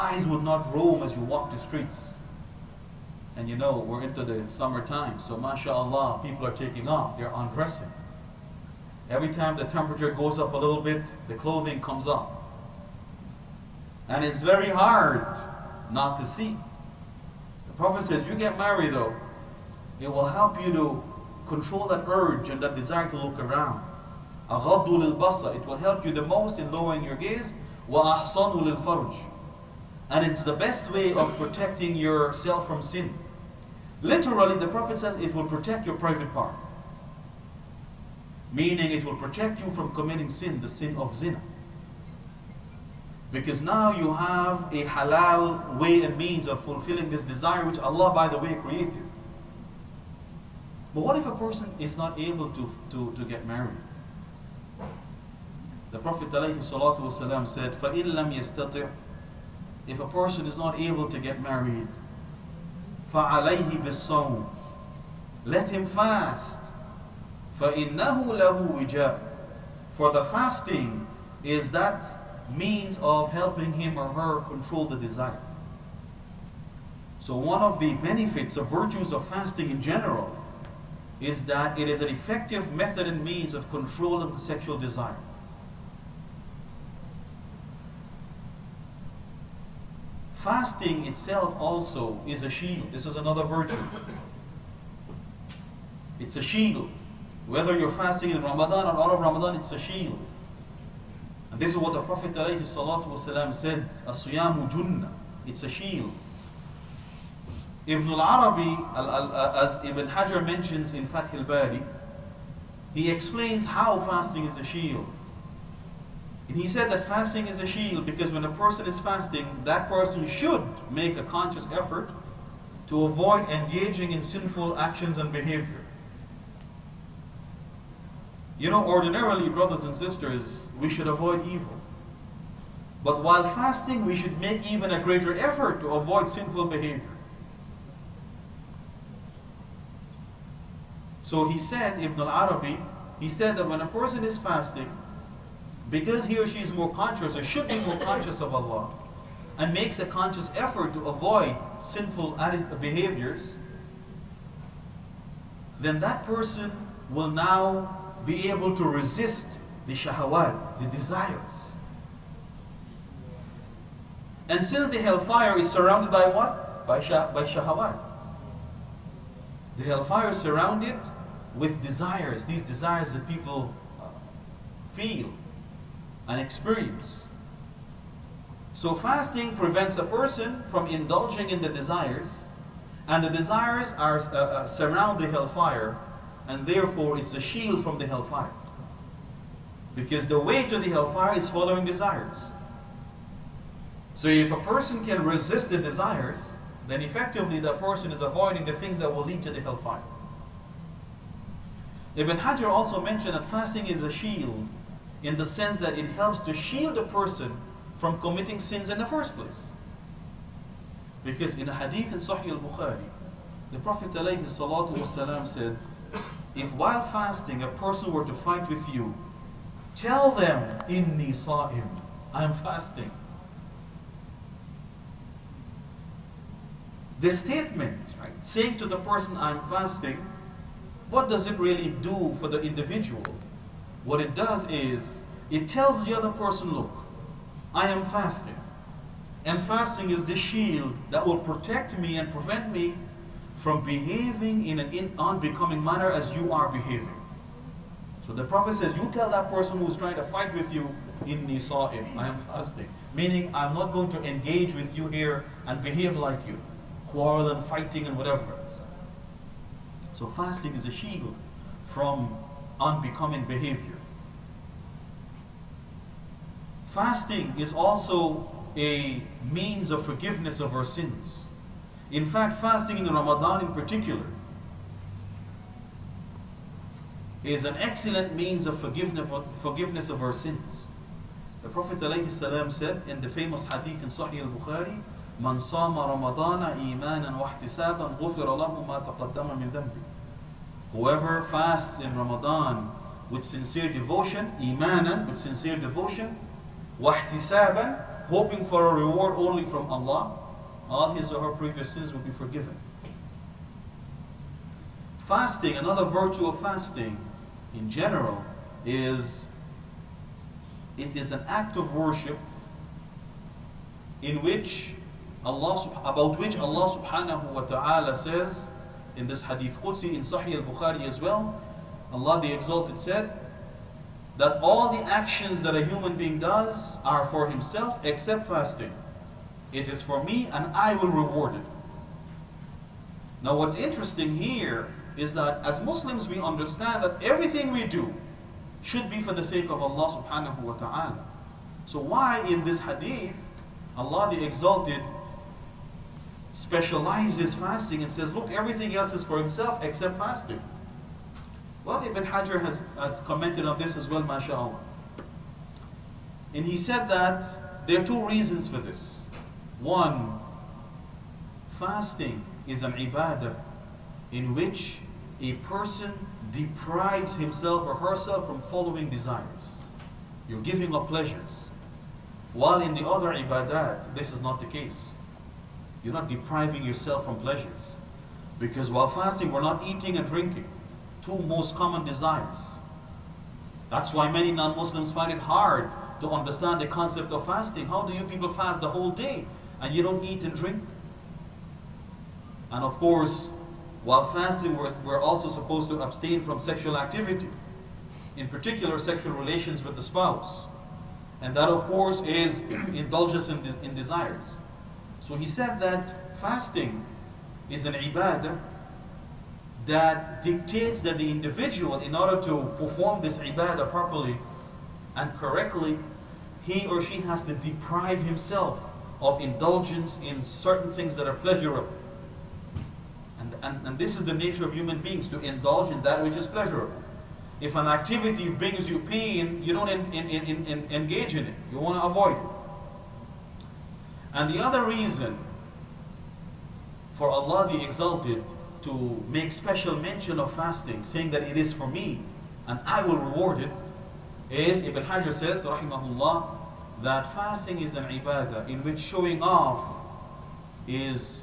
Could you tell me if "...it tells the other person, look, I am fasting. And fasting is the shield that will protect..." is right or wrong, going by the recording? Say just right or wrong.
right.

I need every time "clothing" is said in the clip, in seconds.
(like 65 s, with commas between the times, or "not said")
11 s.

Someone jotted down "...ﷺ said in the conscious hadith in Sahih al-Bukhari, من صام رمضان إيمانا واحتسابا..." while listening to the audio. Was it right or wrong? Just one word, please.
wrong.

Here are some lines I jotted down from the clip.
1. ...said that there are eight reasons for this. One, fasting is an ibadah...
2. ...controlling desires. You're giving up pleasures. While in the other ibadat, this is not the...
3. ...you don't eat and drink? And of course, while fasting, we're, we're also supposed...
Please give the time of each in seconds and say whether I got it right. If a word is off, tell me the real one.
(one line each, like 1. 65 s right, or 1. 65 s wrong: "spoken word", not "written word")
1. 356 s wrong: "two", not "eight"
2. 368 s wrong: "following", not "controlling"
3. 389 s right.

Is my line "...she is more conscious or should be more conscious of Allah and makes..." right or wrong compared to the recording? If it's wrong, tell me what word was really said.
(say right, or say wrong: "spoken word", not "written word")
right.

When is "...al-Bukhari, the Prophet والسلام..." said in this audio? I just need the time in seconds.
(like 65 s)
212 s.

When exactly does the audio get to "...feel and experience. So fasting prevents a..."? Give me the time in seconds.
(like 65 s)
174 s.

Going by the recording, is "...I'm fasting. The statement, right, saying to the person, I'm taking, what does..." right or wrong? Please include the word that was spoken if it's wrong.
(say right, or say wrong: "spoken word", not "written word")
wrong: "fasting", not "taking".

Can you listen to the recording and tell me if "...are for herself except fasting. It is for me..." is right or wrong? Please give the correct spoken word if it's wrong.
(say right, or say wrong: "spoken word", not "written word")
wrong: "himself", not "herself".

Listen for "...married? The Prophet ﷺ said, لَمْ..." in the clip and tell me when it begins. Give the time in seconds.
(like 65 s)
53 s.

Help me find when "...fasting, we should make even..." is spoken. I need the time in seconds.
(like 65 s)
133 s.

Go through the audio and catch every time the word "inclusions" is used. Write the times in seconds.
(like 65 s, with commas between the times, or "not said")
not said.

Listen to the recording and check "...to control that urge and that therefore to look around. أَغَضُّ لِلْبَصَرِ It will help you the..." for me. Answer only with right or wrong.
wrong.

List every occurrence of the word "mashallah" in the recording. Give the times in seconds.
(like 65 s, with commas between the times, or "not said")
5 s, 354 s.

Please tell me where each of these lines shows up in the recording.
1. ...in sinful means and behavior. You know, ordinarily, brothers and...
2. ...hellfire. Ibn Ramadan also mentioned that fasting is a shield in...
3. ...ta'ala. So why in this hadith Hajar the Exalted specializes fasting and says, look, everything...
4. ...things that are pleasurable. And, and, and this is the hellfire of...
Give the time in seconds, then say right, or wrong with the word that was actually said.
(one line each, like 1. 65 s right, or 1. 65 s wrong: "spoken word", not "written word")
1. 124 s wrong: "actions", not "means"
2. 199 s wrong: "Hajar", not "Ramadan"
3. 340 s wrong: "Allah", not "Hajar"
4. 420 s wrong: "nature", not "hellfire".